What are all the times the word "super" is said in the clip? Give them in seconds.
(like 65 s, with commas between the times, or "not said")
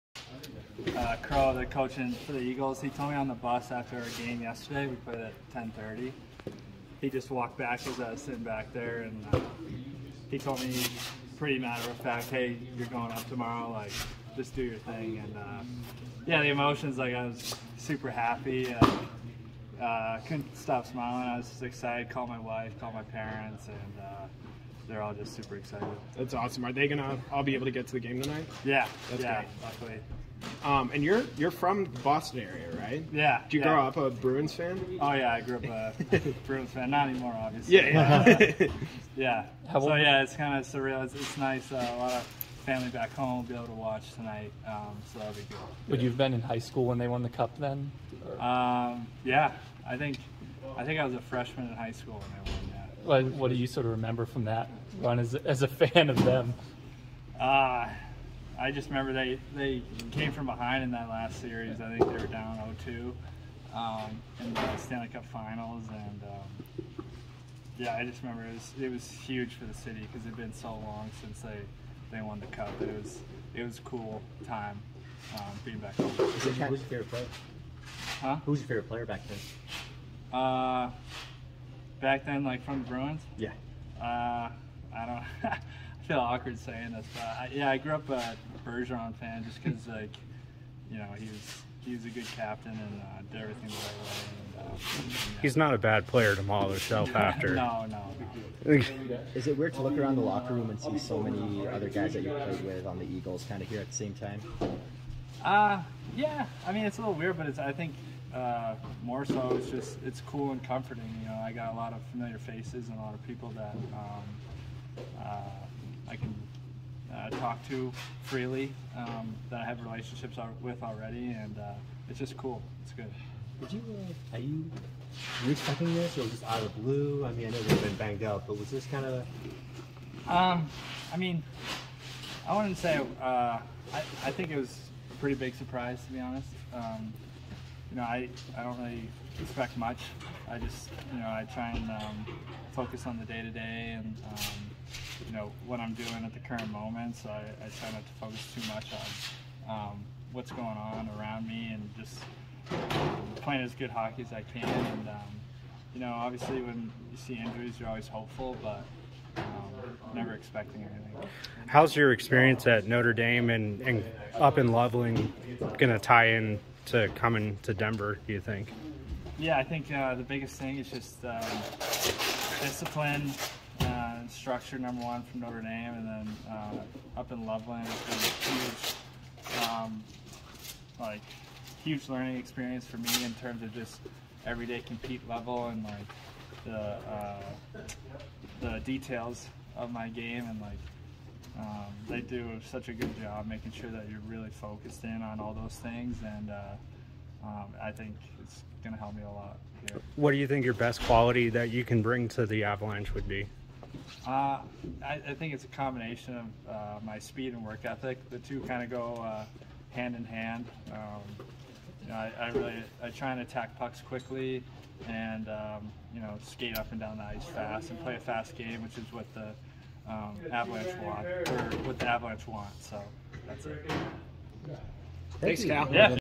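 17 s, 25 s.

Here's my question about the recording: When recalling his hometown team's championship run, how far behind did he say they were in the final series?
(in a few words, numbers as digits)
0-2.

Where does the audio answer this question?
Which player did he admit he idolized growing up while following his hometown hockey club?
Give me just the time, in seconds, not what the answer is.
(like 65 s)
88 s.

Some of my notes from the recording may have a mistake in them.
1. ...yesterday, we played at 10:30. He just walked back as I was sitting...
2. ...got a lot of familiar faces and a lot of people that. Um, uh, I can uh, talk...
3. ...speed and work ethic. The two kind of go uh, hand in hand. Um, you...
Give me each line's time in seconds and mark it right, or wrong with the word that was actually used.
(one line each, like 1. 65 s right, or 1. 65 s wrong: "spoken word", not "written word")
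1. 4 s right
2. 111 s right
3. 207 s right.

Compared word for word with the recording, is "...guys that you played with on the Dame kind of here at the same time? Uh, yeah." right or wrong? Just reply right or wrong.
wrong.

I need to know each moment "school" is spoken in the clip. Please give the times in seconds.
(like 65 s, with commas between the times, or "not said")
46 s, 51 s.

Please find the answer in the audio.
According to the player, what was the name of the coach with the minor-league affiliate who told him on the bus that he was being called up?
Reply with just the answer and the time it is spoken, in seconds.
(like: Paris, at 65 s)
Crow, at 1 s.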